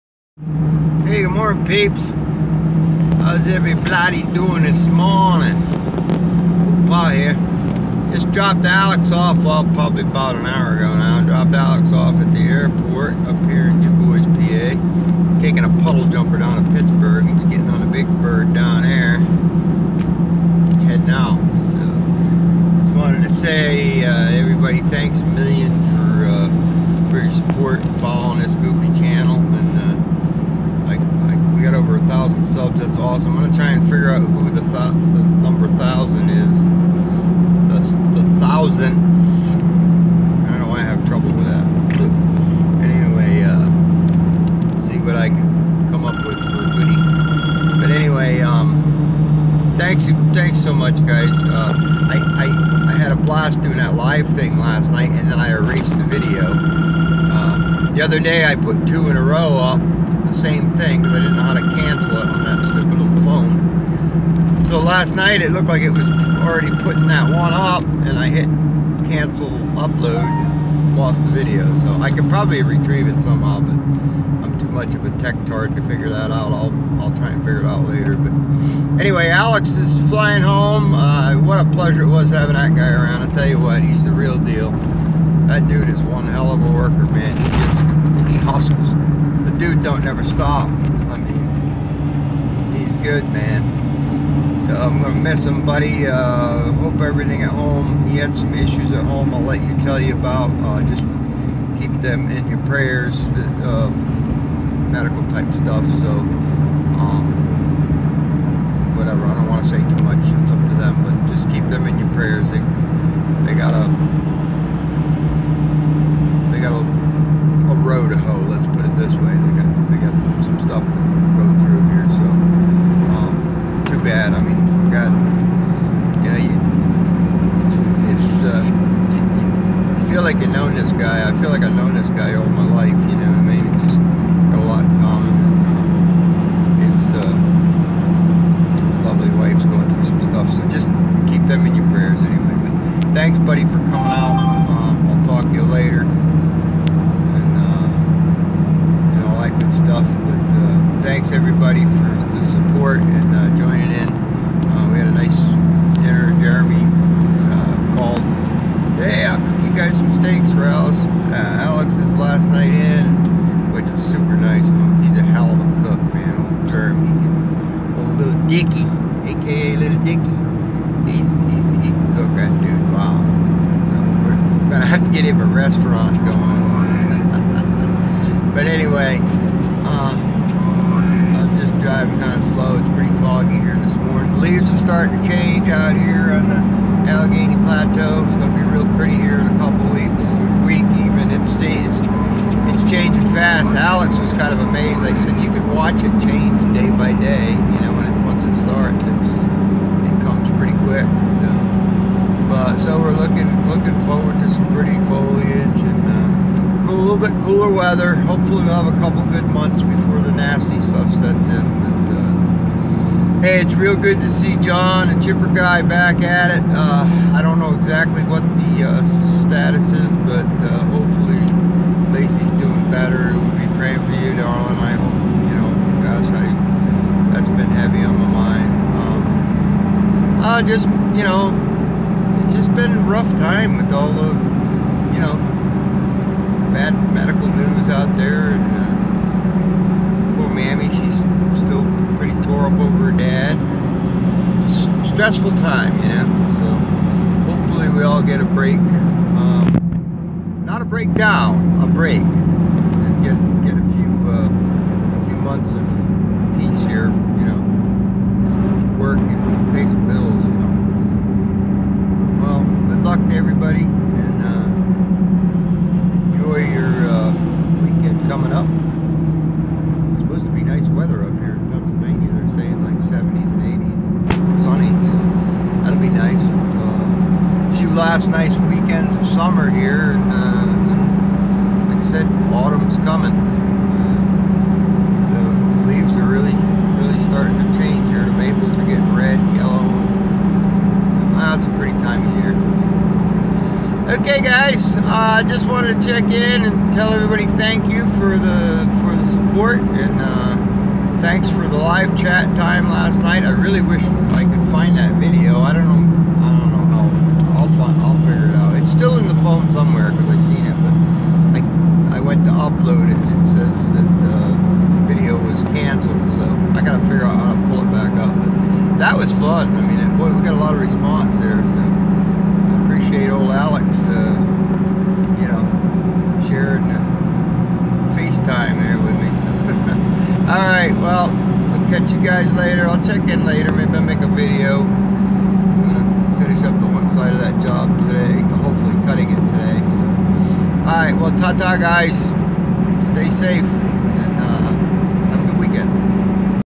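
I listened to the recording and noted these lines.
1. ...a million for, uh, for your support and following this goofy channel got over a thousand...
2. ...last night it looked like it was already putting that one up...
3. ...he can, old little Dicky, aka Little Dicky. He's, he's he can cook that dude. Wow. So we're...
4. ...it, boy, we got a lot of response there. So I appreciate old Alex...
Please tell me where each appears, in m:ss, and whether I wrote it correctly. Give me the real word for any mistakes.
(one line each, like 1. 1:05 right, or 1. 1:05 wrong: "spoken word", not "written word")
1. 0:25 right
2. 1:04 right
3. 2:47 right
4. 5:19 right.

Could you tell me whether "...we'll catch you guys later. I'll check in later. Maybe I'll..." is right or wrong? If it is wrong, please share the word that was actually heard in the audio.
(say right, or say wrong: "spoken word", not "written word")
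right.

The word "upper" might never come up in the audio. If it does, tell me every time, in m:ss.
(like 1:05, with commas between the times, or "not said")
not said.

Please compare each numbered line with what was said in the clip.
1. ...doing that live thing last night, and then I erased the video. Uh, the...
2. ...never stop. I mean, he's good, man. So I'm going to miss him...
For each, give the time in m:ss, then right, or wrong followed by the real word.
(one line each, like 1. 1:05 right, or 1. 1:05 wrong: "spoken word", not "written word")
1. 0:53 right
2. 1:30 right.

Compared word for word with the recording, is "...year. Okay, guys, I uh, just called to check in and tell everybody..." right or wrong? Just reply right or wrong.
wrong.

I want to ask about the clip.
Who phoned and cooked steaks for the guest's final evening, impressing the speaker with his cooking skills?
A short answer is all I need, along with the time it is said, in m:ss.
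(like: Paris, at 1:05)
Jeremy, at 2:36.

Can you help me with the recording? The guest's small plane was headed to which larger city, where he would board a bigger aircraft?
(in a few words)
Pittsburgh.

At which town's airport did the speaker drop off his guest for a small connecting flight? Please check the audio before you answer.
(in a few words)
Du Bois, PA.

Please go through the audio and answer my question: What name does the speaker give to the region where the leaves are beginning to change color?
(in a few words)
Allegheny Plateau.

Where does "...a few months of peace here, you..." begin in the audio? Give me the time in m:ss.
4:14.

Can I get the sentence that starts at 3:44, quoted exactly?
I hope, you know, gosh, I, that's been heavy on my mind.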